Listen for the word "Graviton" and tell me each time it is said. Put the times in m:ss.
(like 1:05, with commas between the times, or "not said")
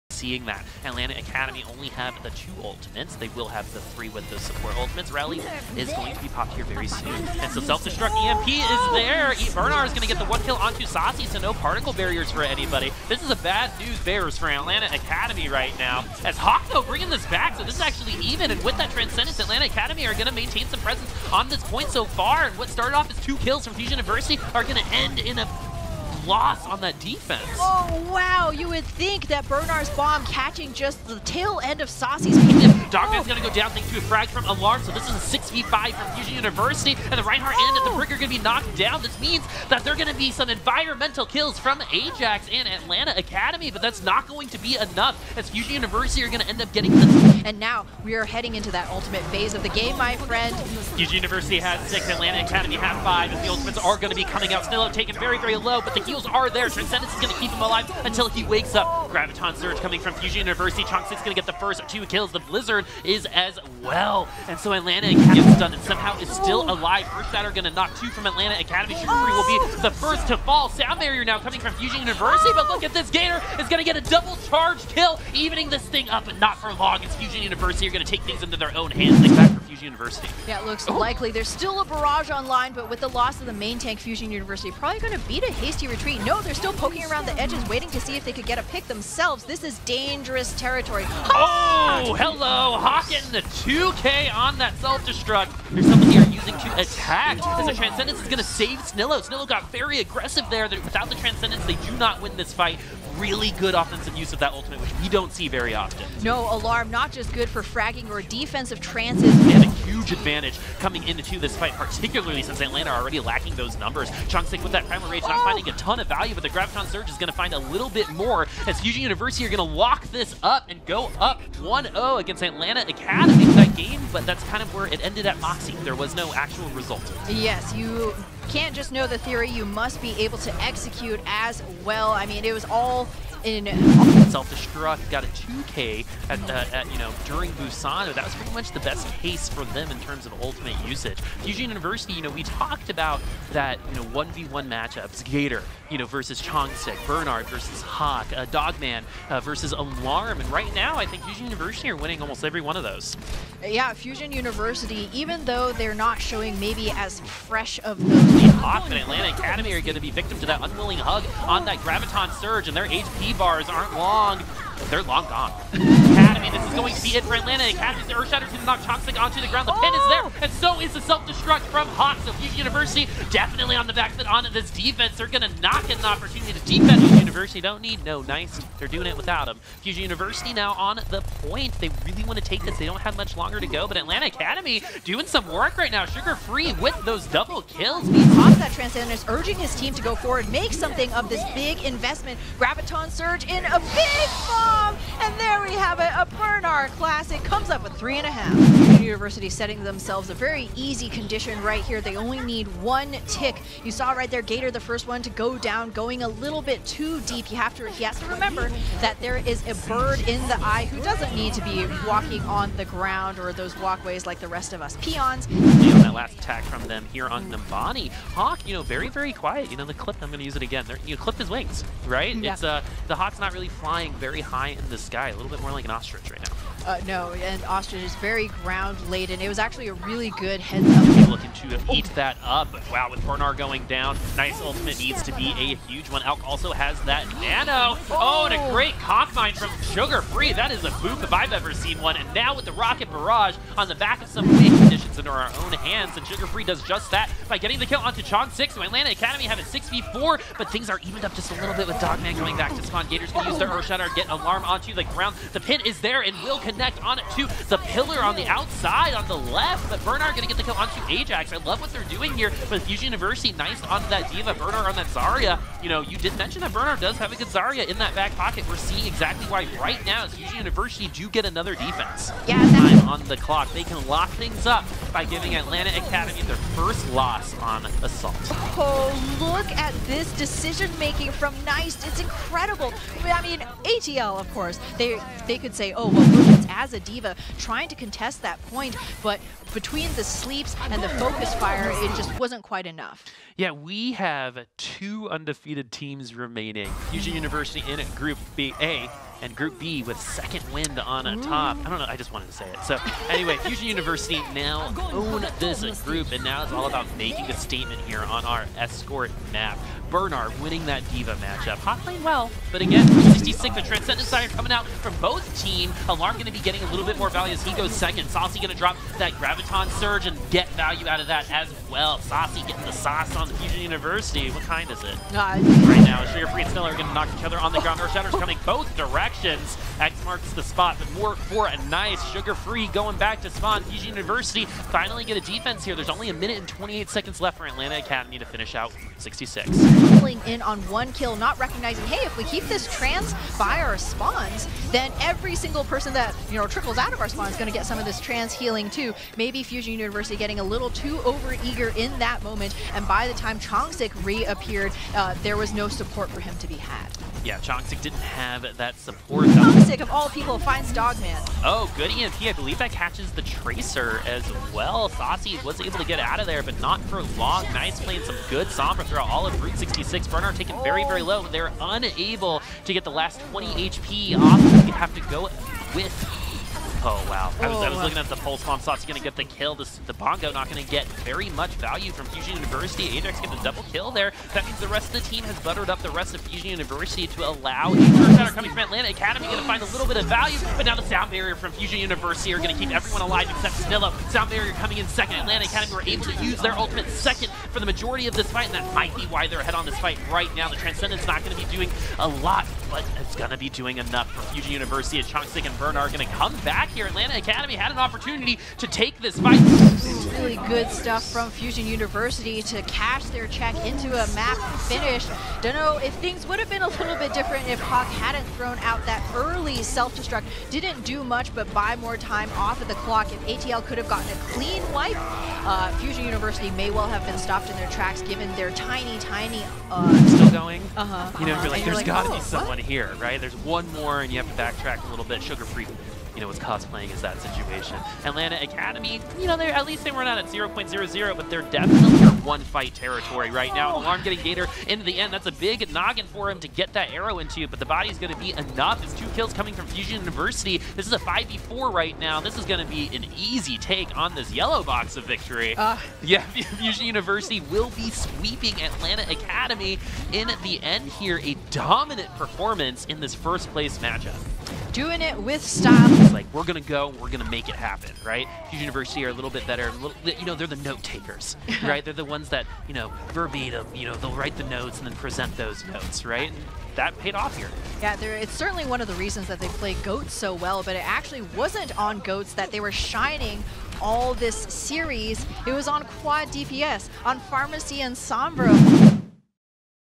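0:59, 1:56, 2:41, 3:12, 5:19.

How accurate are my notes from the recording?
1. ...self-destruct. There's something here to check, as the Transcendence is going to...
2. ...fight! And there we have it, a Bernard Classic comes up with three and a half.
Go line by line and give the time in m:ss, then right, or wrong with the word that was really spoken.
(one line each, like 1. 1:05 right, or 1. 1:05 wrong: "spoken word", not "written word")
1. 1:34 wrong: "attack", not "check"
2. 3:14 right.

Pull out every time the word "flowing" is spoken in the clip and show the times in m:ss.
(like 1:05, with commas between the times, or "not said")
not said.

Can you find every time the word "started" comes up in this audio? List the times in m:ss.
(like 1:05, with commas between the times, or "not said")
0:22.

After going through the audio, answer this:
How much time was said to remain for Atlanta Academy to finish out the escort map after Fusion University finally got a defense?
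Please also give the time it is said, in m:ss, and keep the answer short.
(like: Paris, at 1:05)
1 minute 28 seconds, at 5:36.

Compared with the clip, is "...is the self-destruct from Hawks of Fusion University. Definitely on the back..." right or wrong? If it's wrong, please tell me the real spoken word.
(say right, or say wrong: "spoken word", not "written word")
right.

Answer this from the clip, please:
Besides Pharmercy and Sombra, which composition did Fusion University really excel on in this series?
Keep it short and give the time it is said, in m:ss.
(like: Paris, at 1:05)
Quad DPS, at 8:06.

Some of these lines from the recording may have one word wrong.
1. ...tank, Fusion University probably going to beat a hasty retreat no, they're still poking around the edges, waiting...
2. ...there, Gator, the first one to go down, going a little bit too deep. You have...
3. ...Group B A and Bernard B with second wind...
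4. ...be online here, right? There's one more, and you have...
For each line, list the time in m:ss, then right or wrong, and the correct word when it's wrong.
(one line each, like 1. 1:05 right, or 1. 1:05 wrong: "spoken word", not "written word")
1. 1:23 right
2. 3:24 right
3. 4:58 wrong: "Group", not "Bernard"
4. 7:12 wrong: "someone", not "online".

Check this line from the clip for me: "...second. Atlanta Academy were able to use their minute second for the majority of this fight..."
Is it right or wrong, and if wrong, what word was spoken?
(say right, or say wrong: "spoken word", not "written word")
wrong: "ultimate", not "minute".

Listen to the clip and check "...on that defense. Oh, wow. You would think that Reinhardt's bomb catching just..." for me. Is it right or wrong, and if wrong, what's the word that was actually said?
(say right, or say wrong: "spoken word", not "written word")
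wrong: "Bernard", not "Reinhardt".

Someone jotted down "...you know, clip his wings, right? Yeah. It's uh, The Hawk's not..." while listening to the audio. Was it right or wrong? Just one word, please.
right.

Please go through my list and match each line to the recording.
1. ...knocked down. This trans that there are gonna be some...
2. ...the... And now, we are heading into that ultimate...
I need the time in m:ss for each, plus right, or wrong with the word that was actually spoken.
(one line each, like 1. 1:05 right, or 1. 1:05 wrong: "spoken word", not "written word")
1. 0:38 wrong: "means", not "trans"
2. 0:46 right.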